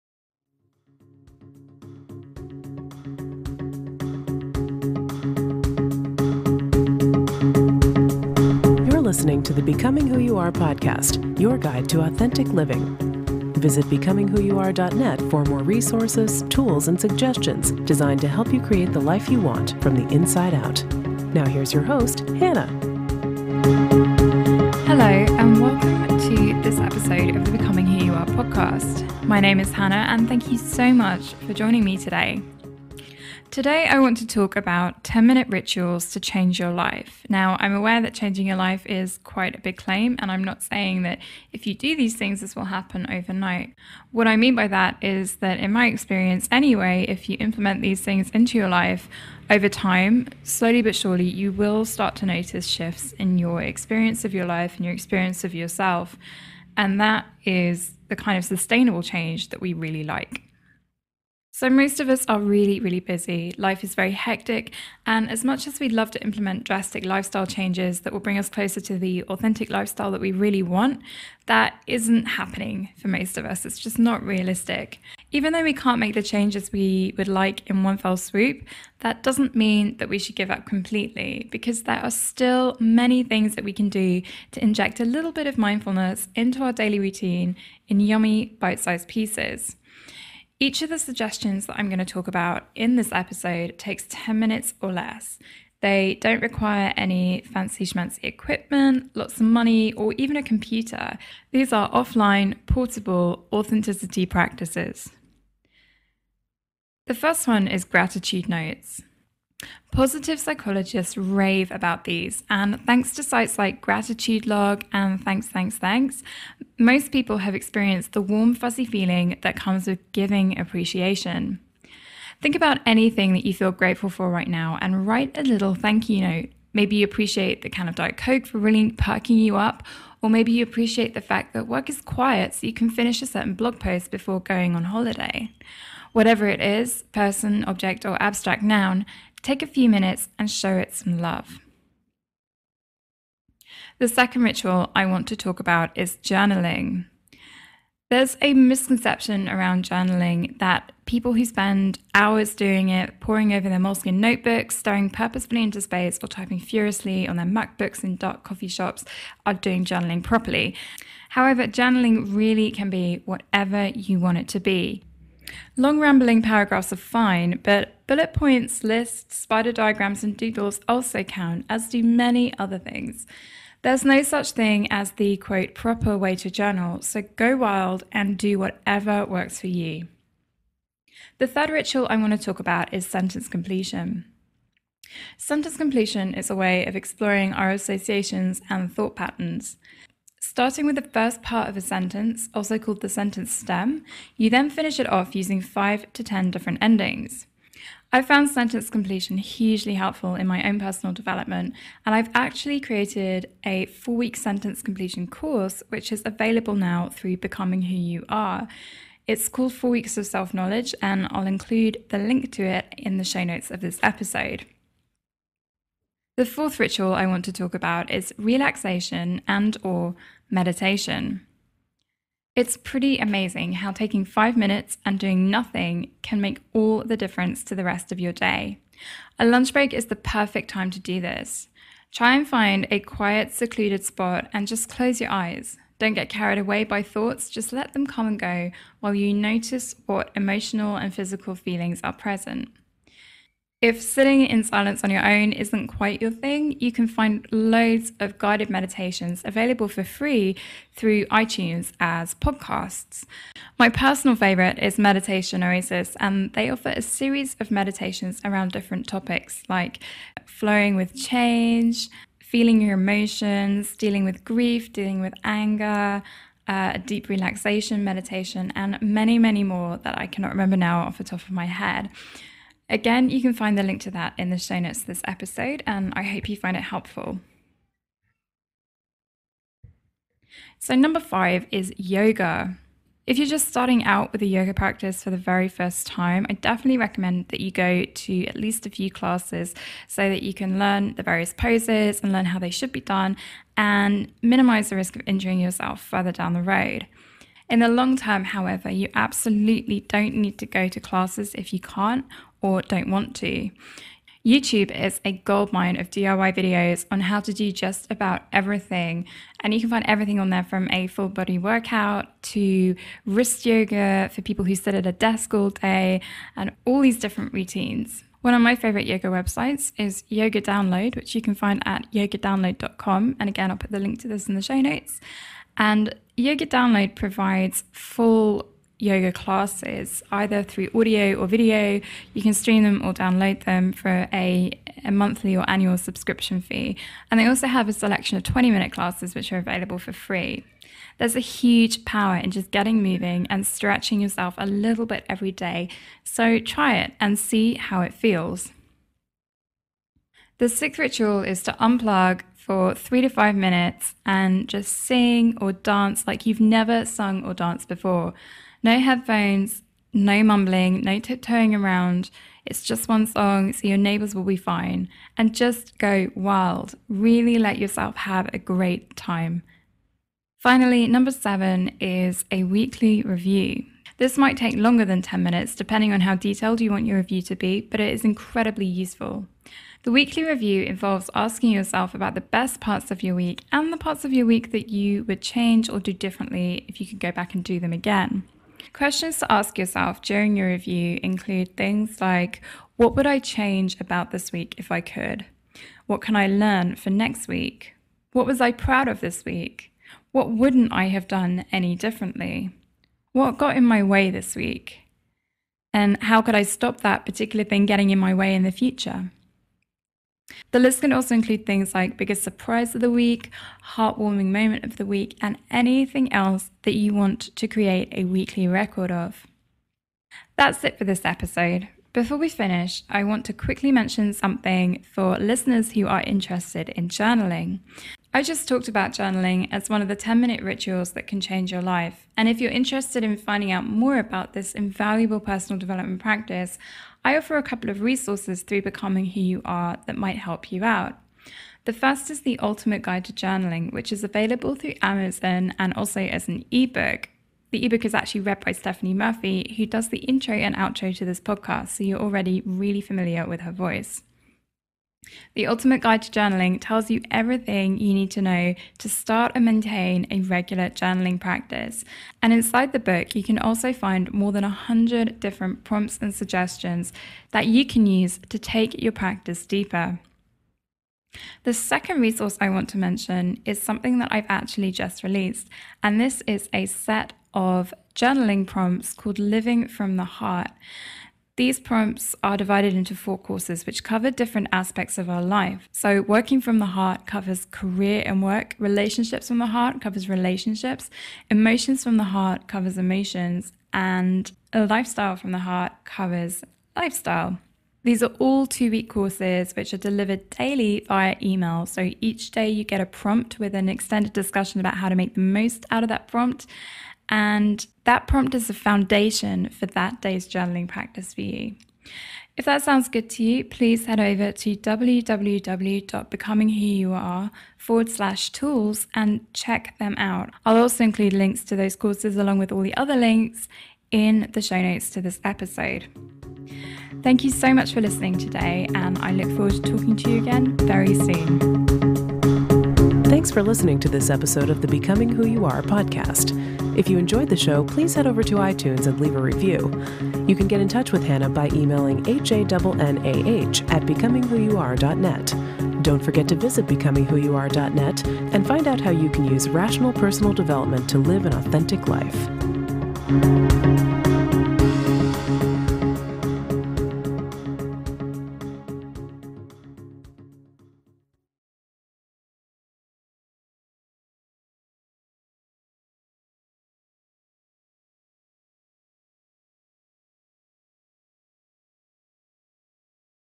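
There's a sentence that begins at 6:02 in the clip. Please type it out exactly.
It's just one song, so your neighbors will be fine.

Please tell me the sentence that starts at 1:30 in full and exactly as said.
Each of the suggestions that I'm going to talk about in this episode takes 10 minutes or less.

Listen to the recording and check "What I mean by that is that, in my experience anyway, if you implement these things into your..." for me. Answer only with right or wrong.
right.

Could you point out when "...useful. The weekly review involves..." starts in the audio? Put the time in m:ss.
6:18.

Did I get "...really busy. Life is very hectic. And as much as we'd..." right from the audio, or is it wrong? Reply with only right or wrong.
right.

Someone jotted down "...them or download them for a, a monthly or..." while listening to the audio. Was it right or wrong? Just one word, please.
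right.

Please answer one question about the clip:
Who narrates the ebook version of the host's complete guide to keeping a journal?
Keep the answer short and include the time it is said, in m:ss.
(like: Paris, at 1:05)
Stephanie Murphy, at 7:28.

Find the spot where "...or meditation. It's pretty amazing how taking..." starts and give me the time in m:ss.
3:39.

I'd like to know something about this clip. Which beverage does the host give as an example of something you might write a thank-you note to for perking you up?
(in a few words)
Diet Coke.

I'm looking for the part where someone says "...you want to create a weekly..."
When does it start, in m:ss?
6:56.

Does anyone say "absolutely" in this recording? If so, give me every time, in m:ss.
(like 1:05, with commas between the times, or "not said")
4:59.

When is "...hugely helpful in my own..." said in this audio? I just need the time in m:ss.
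3:19.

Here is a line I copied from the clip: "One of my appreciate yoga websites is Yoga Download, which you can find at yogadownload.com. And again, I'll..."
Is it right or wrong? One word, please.
wrong.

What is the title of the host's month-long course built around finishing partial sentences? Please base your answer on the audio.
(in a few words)
Four Weeks of Self Knowledge.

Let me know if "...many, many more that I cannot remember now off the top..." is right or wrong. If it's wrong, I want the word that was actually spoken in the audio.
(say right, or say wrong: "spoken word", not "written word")
right.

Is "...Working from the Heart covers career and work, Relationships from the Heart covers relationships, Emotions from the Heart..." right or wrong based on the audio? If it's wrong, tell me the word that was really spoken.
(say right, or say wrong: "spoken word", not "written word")
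right.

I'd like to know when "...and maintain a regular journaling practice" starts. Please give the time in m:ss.
7:39.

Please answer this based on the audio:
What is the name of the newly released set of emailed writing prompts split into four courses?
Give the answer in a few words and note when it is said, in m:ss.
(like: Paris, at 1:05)
Living from the Heart, at 7:59.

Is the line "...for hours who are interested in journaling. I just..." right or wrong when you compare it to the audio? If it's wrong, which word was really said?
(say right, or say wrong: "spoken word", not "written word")
wrong: "listeners", not "hours".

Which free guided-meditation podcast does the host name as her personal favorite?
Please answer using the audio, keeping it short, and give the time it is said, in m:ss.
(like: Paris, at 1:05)
Meditation Oasis, at 4:14.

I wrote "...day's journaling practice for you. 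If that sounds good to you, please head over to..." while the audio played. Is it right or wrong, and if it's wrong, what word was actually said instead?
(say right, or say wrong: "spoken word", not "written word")
right.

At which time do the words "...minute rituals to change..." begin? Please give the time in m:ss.
0:35.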